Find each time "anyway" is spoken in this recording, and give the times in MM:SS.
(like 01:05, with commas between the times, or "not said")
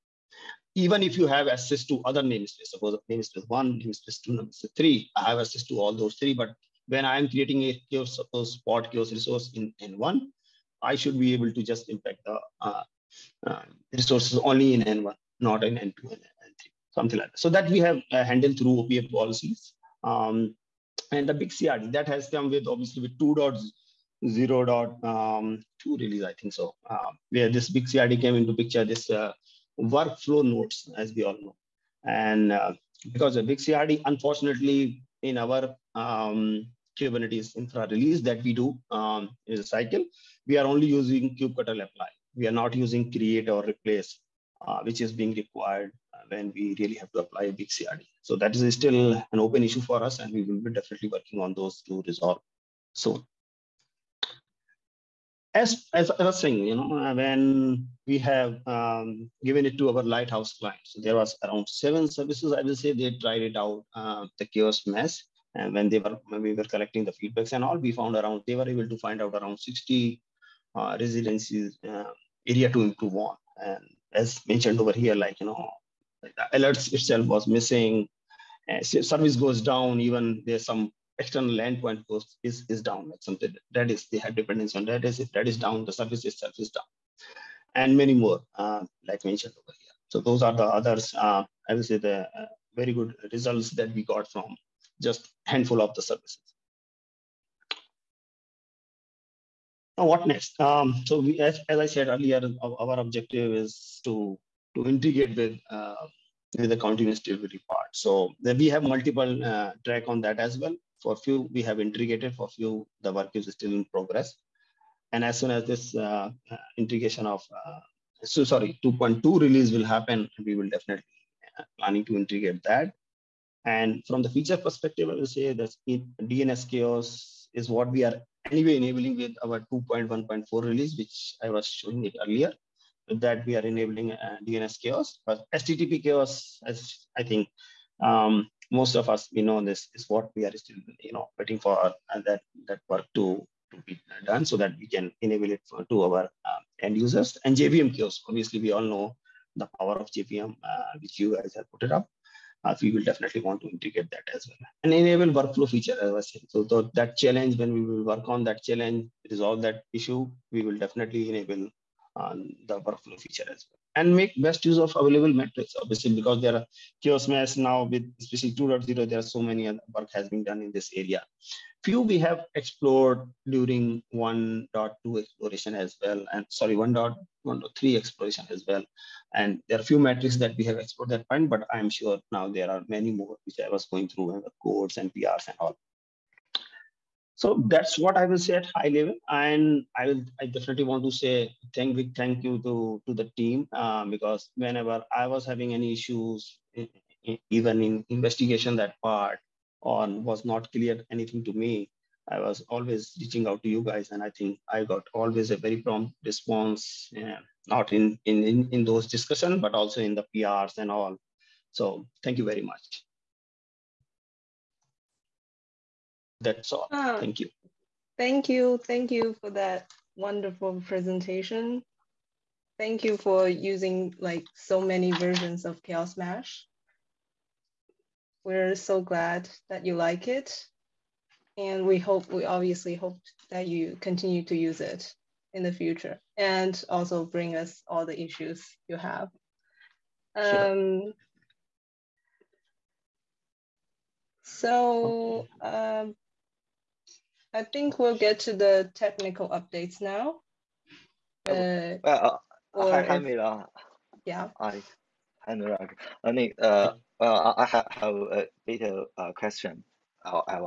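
02:08.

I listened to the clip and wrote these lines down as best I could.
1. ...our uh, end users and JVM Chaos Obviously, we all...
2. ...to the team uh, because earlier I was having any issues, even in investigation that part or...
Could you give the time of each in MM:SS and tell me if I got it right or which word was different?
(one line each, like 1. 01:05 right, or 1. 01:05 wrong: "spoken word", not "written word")
1. 02:26 right
2. 03:13 wrong: "whenever", not "earlier".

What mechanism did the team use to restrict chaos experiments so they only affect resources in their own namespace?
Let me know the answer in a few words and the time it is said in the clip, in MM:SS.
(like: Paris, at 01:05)
OPA policies, at 00:18.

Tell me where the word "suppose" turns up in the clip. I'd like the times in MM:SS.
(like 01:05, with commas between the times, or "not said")
00:02, 00:08.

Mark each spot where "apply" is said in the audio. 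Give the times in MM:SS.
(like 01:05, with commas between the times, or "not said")
00:41, 00:47.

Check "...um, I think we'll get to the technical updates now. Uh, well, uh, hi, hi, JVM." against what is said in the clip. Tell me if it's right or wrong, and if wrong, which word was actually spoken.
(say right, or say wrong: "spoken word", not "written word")
wrong: "Mila", not "JVM".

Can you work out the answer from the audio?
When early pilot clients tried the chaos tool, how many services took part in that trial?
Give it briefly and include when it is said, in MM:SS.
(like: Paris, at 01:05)
7, at 01:01.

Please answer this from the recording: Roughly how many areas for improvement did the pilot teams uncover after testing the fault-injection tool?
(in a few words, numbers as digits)
60.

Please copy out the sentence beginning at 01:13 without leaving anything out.
And as mentioned over here, like you know, alerts itself was missing.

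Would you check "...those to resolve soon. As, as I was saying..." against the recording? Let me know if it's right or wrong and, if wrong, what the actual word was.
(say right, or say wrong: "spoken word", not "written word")
right.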